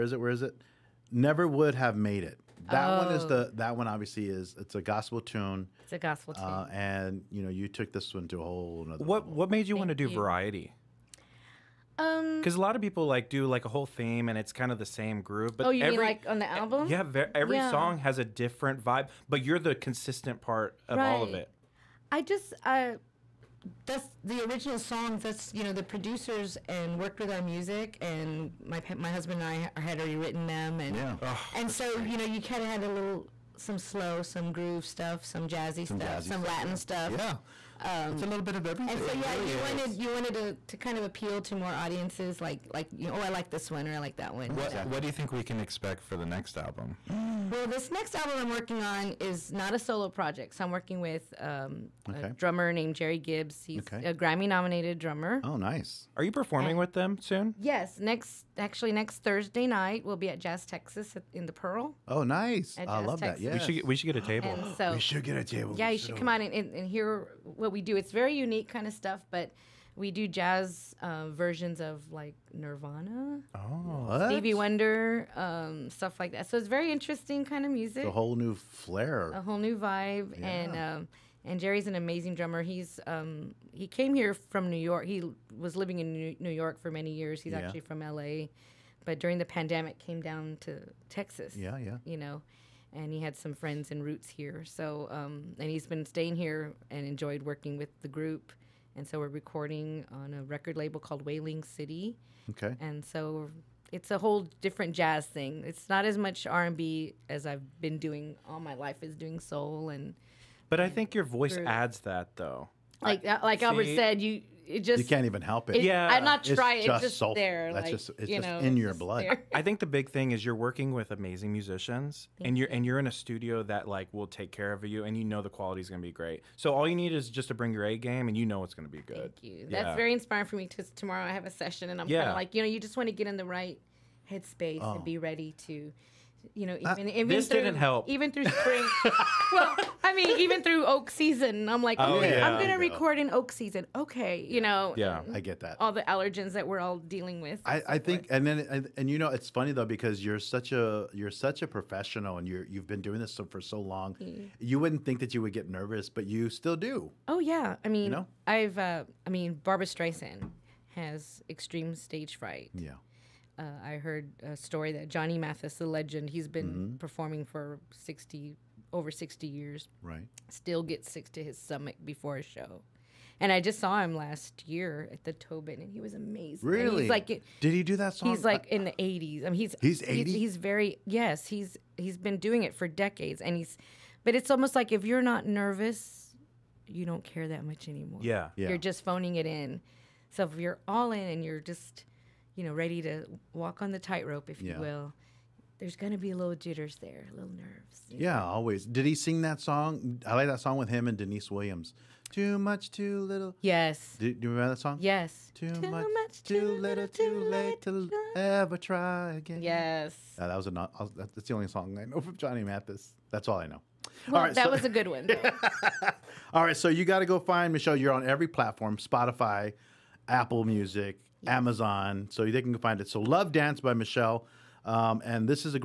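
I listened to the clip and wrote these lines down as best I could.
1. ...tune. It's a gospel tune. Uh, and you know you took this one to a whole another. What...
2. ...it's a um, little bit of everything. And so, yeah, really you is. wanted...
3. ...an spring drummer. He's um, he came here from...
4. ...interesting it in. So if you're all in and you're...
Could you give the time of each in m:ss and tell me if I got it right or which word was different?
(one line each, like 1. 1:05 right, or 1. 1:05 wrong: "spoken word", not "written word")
1. 0:05 right
2. 0:38 right
3. 1:21 wrong: "amazing", not "spring"
4. 3:09 wrong: "phoning", not "interesting".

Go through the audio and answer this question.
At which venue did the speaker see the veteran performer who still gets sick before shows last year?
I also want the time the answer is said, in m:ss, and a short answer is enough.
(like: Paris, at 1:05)
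The Tobin, at 2:55.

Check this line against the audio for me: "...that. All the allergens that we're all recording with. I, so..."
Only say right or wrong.
wrong.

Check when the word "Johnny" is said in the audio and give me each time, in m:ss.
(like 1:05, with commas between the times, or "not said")
2:45, 3:32.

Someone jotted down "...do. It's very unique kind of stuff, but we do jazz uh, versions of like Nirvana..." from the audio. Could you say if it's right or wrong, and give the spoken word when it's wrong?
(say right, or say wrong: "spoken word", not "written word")
right.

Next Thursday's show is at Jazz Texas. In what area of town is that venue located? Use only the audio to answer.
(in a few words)
The Pearl.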